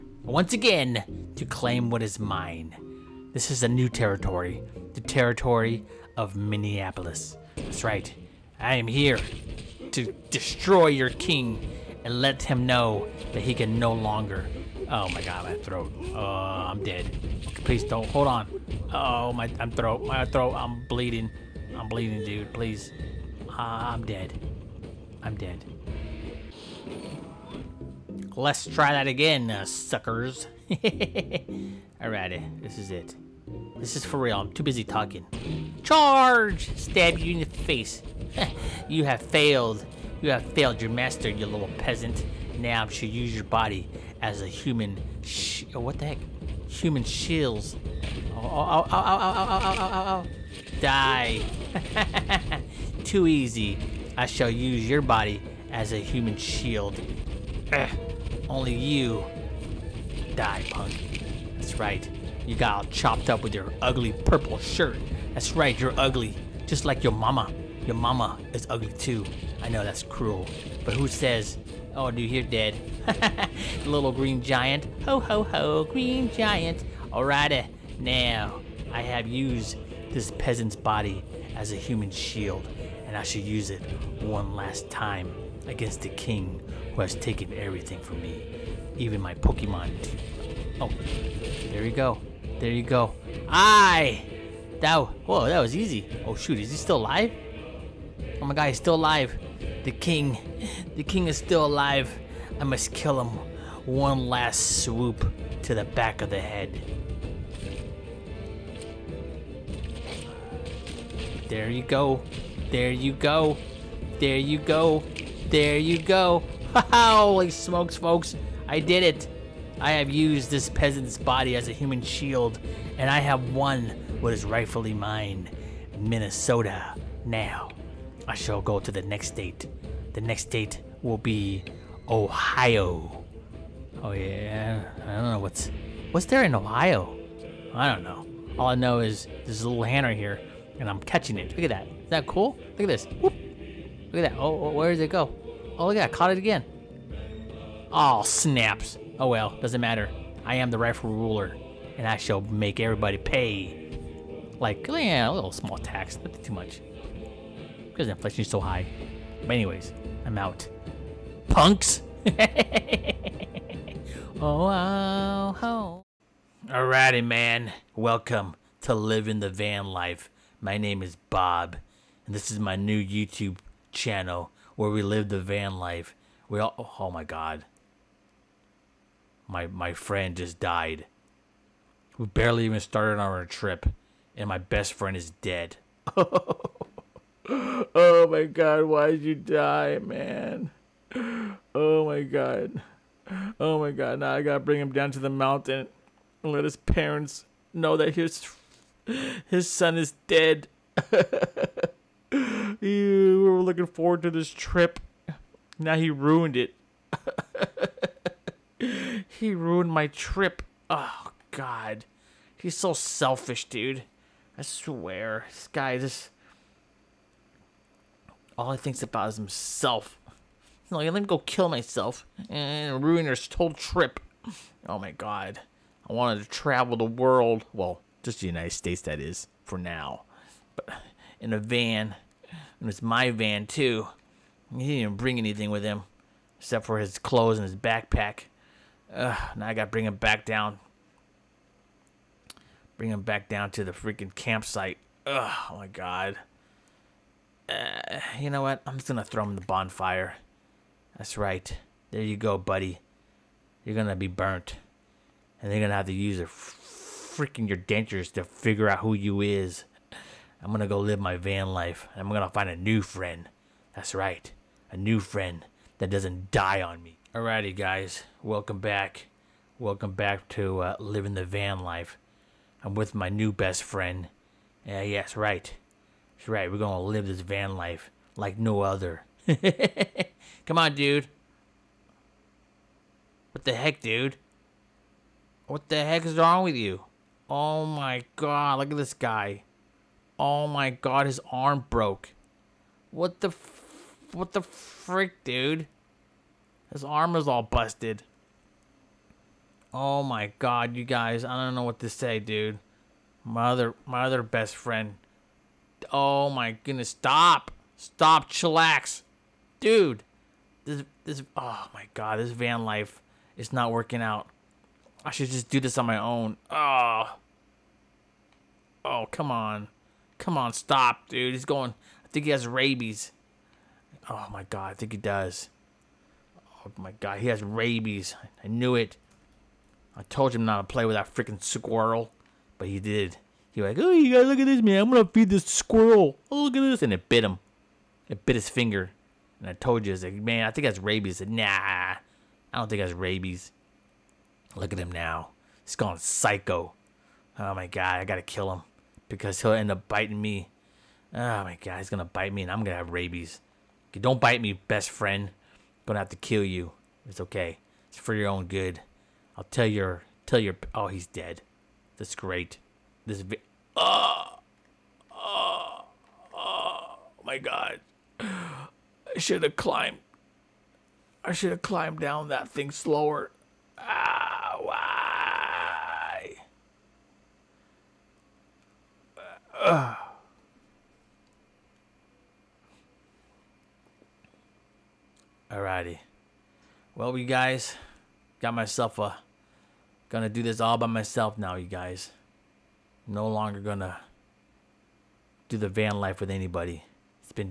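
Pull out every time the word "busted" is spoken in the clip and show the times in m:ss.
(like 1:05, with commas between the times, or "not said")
4:57.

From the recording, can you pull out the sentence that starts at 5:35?
I'm going to feed this squirrel.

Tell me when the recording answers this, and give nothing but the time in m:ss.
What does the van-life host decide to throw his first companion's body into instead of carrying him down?
4:09.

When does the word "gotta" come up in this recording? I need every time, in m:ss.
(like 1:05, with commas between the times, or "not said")
3:14, 3:59, 5:48.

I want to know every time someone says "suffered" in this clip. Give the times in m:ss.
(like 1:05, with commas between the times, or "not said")
not said.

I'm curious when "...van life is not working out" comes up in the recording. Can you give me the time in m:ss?
5:12.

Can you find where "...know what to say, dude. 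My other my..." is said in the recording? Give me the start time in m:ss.
5:01.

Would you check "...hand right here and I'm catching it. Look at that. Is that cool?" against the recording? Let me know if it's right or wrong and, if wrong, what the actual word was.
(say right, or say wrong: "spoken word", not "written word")
right.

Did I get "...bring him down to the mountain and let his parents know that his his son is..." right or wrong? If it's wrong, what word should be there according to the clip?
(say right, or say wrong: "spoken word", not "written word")
right.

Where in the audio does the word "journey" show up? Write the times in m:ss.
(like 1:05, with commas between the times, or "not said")
not said.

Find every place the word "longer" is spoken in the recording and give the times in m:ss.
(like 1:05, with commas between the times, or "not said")
0:13, 6:33.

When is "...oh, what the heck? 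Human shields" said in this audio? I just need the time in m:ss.
0:45.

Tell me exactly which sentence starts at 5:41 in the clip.
nah, I don't think that's rabies.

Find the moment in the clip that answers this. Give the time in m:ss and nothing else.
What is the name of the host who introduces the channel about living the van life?
2:51.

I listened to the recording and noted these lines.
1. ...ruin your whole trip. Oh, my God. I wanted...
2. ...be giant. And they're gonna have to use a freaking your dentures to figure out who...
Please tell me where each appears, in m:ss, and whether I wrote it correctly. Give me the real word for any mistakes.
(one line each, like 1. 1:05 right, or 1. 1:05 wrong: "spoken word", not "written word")
1. 3:43 right
2. 4:14 wrong: "burnt", not "giant".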